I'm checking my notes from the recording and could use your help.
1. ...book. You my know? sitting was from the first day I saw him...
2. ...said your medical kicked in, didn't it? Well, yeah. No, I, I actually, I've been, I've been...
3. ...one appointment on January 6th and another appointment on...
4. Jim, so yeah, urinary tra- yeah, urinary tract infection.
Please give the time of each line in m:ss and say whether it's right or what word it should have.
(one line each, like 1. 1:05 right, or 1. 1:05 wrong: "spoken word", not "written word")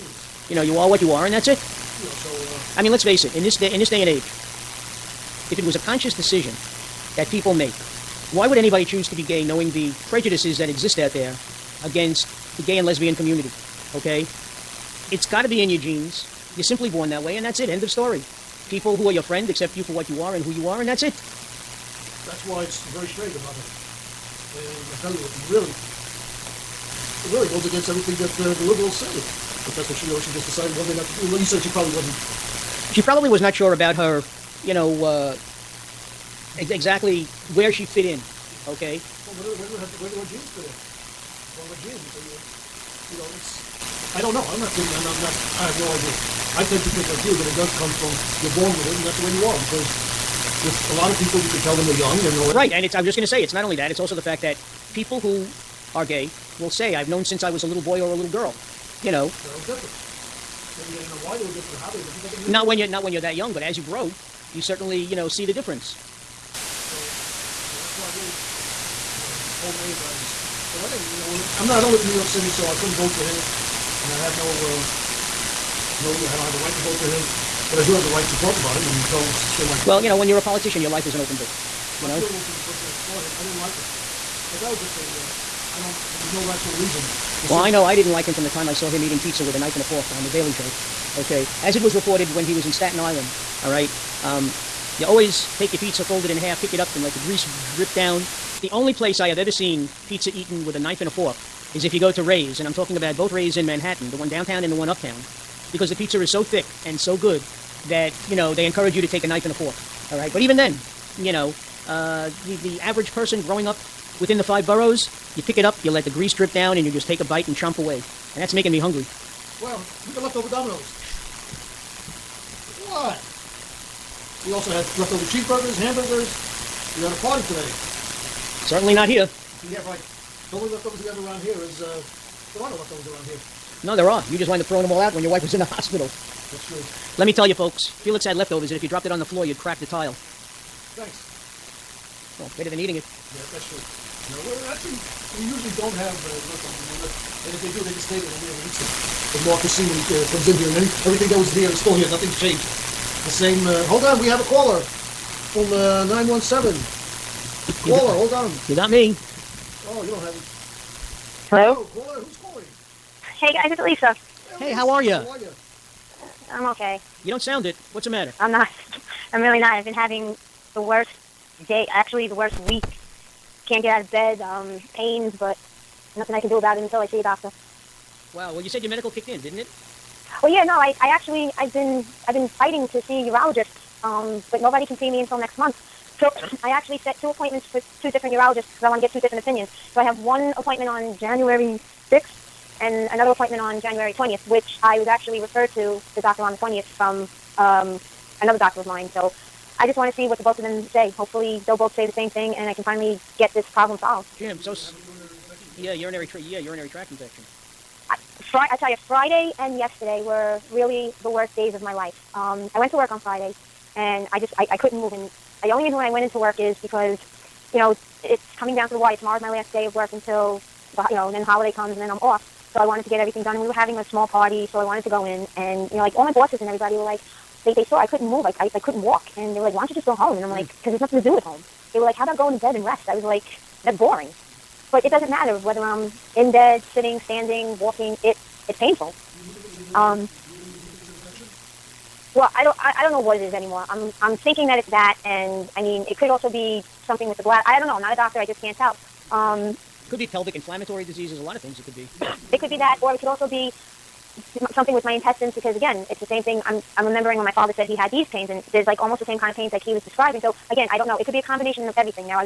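1. 1:21 wrong: "feeling", not "sitting"
2. 2:58 right
3. 3:10 right
4. 3:24 right.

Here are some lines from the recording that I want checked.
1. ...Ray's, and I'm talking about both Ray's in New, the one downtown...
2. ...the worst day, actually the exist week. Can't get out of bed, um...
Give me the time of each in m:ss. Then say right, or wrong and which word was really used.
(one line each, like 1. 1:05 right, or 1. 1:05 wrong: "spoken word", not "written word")
1. 1:42 wrong: "Manhattan", not "New"
2. 2:50 wrong: "worst", not "exist".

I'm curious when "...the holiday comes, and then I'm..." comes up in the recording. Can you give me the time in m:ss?
3:41.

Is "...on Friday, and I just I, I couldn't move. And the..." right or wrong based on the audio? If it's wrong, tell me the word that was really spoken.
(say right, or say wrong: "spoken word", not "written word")
right.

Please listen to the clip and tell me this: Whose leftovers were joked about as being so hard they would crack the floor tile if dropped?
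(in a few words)
Felix.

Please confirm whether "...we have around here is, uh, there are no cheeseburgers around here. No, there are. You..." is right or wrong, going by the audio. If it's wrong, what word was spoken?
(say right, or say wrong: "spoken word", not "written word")
wrong: "leftovers", not "cheeseburgers".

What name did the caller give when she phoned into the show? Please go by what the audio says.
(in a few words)
Lisa.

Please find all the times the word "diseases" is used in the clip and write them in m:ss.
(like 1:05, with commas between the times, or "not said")
4:11.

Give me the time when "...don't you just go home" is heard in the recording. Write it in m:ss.
3:49.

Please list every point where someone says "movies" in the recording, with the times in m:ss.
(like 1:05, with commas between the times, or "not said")
not said.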